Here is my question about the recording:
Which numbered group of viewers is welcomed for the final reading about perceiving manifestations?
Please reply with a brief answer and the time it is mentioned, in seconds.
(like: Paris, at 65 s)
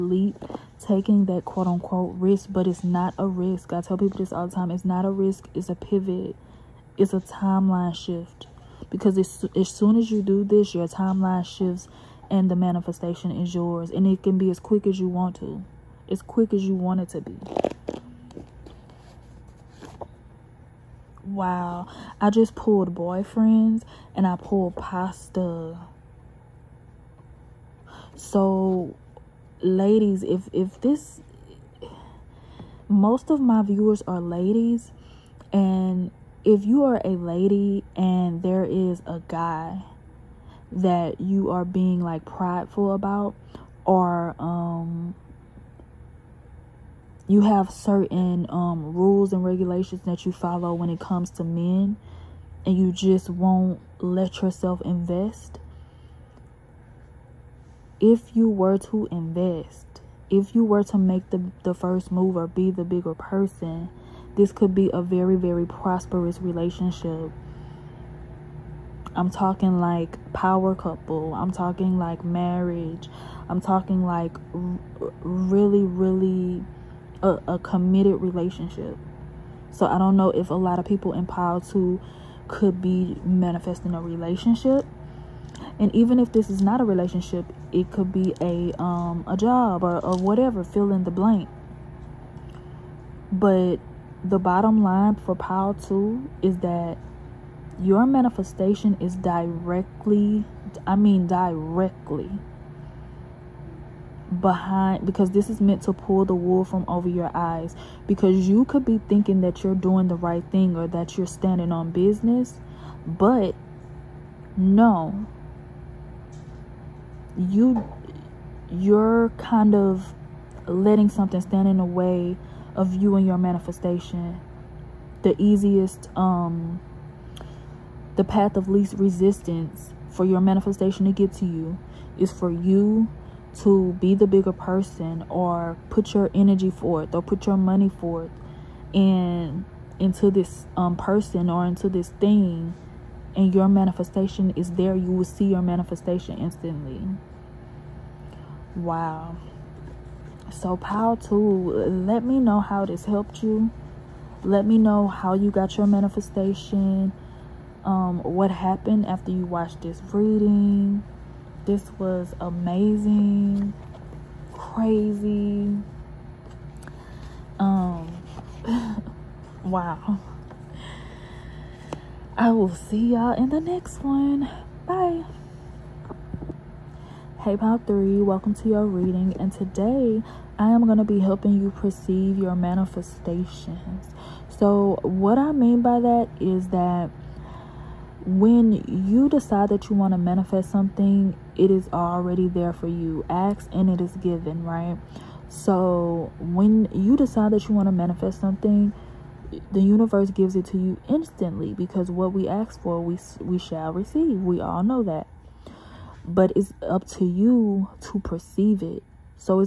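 Pile 3, at 177 s.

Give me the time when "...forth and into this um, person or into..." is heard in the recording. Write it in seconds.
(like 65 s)
137 s.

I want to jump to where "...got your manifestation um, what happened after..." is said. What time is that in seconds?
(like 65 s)
155 s.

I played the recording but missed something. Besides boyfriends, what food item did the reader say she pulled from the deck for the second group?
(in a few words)
Pasta.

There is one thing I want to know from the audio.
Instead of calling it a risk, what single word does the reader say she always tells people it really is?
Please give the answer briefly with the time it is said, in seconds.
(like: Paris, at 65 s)
A pivot, at 5 s.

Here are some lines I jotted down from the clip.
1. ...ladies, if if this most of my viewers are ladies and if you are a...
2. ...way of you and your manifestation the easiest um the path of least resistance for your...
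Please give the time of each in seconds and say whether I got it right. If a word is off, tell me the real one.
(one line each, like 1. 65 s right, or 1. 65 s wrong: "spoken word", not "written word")
1. 29 s right
2. 121 s right.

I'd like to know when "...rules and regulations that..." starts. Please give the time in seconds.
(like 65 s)
48 s.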